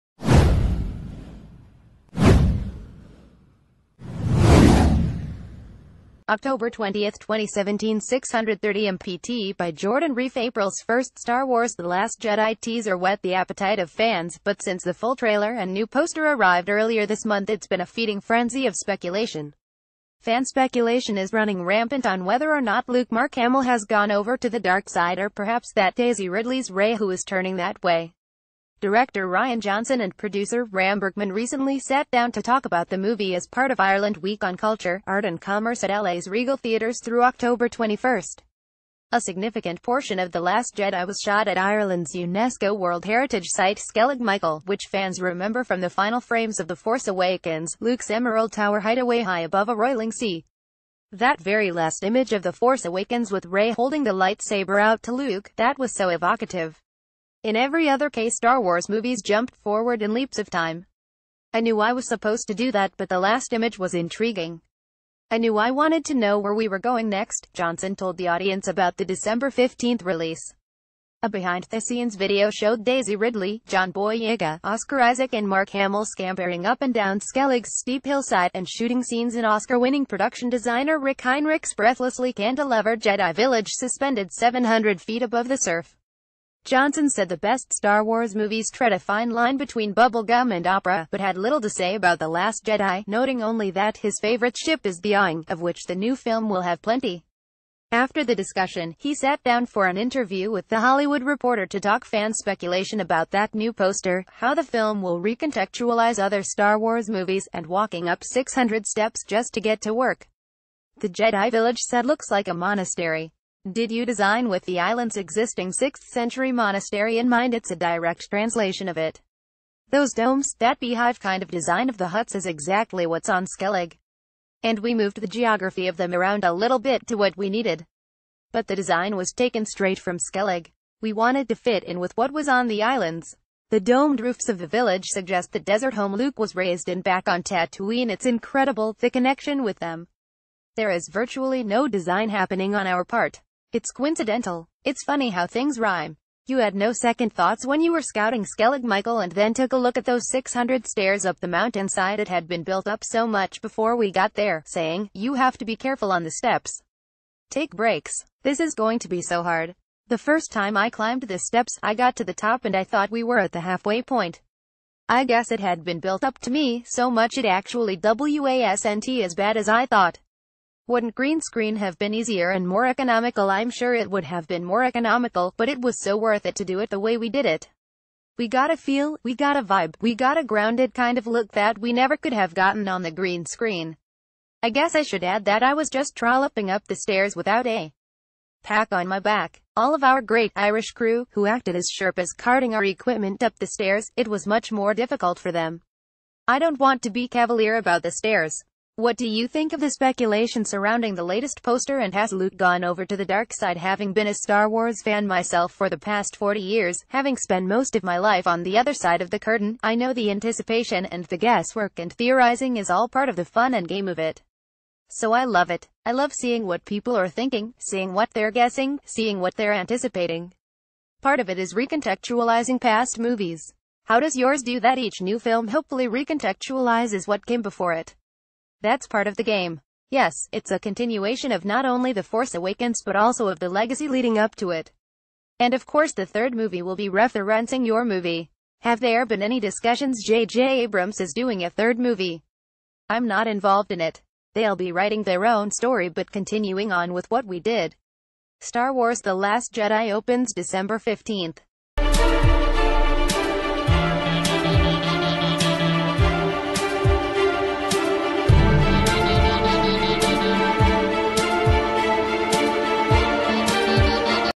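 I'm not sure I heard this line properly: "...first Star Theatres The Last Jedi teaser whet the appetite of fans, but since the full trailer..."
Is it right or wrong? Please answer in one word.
wrong.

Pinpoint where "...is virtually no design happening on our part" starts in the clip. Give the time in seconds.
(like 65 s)
140 s.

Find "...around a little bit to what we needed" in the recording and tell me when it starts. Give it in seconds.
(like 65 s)
126 s.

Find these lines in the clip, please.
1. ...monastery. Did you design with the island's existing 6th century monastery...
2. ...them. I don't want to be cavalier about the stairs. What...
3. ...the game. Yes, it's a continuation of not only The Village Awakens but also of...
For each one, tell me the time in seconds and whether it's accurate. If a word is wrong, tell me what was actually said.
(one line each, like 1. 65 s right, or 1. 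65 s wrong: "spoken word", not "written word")
1. 112 s right
2. 195 s right
3. 229 s wrong: "Force", not "Village".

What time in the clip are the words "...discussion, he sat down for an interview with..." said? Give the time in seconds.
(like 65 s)
98 s.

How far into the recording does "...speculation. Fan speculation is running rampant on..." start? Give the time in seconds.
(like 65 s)
18 s.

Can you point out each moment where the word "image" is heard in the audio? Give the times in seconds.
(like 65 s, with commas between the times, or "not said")
52 s, 63 s.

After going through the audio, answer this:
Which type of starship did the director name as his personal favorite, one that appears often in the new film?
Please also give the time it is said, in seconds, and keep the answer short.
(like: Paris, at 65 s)
Y-wing, at 95 s.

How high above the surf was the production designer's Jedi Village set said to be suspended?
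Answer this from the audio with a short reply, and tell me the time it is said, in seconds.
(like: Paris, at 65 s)
700 feet, at 84 s.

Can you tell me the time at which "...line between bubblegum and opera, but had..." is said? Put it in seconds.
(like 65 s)
89 s.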